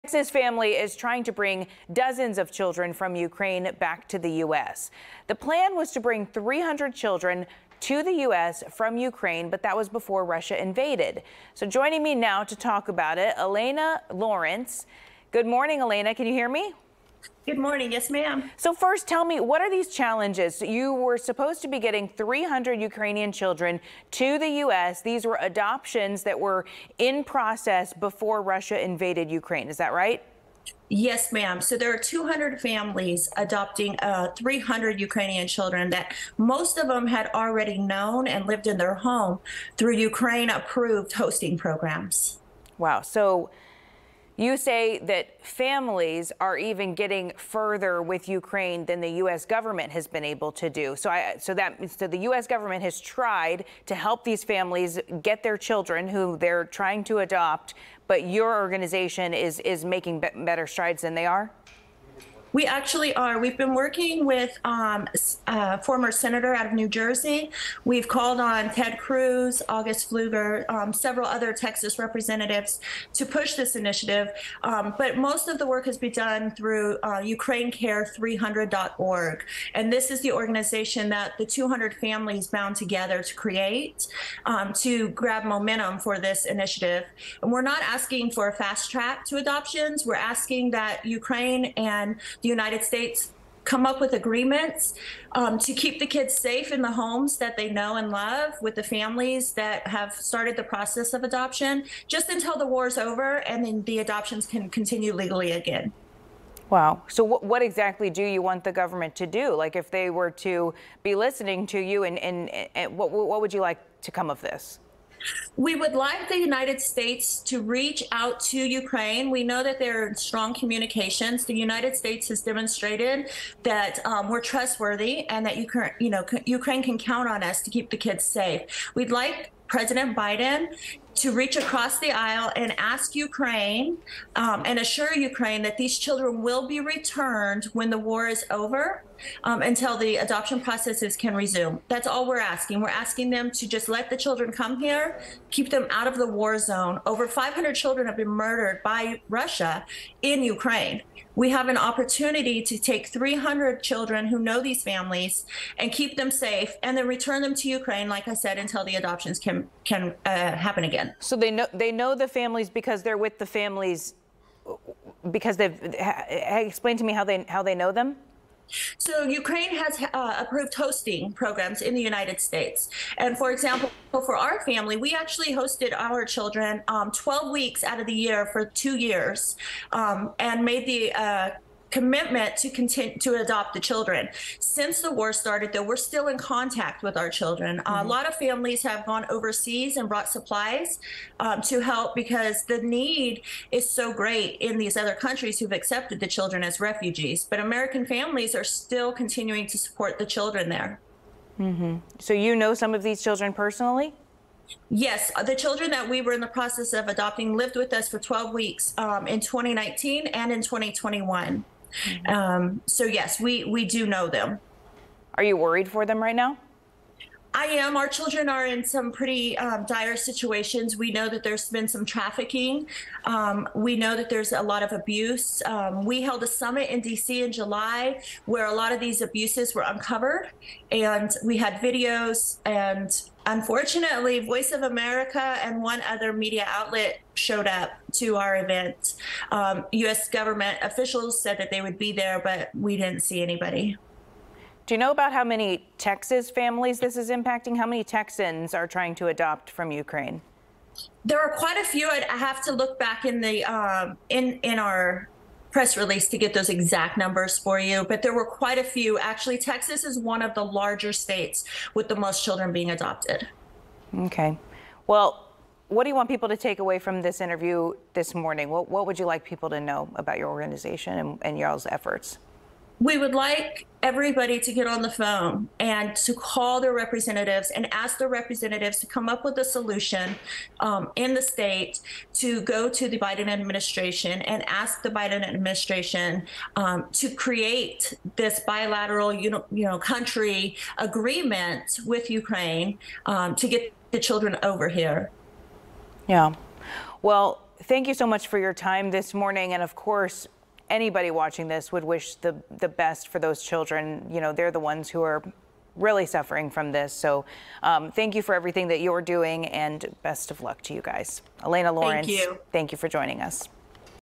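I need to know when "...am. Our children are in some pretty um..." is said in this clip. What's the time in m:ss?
3:37.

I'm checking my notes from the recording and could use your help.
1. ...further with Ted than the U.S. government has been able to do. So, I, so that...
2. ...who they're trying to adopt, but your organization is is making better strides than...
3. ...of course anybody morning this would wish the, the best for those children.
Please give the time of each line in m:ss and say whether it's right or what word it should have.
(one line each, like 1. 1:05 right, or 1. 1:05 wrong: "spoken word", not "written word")
1. 0:47 wrong: "Ukraine", not "Ted"
2. 0:56 right
3. 4:59 wrong: "watching", not "morning".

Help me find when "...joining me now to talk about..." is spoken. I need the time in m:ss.
0:11.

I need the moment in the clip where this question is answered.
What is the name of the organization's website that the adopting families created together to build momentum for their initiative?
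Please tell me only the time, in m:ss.
1:17.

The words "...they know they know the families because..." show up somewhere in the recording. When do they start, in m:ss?
2:41.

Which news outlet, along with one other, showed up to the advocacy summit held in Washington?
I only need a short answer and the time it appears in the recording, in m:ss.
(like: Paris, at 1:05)
Voice of America, at 3:54.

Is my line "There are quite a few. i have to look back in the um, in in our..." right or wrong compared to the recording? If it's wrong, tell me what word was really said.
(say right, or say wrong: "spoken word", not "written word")
right.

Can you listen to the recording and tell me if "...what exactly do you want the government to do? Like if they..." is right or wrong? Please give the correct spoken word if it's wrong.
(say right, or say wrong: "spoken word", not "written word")
right.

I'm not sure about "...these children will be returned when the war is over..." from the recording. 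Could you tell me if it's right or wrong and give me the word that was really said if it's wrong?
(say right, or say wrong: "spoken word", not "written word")
right.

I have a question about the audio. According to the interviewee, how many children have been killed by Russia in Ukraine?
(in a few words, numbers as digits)
Over 500.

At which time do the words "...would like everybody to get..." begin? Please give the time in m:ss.
4:33.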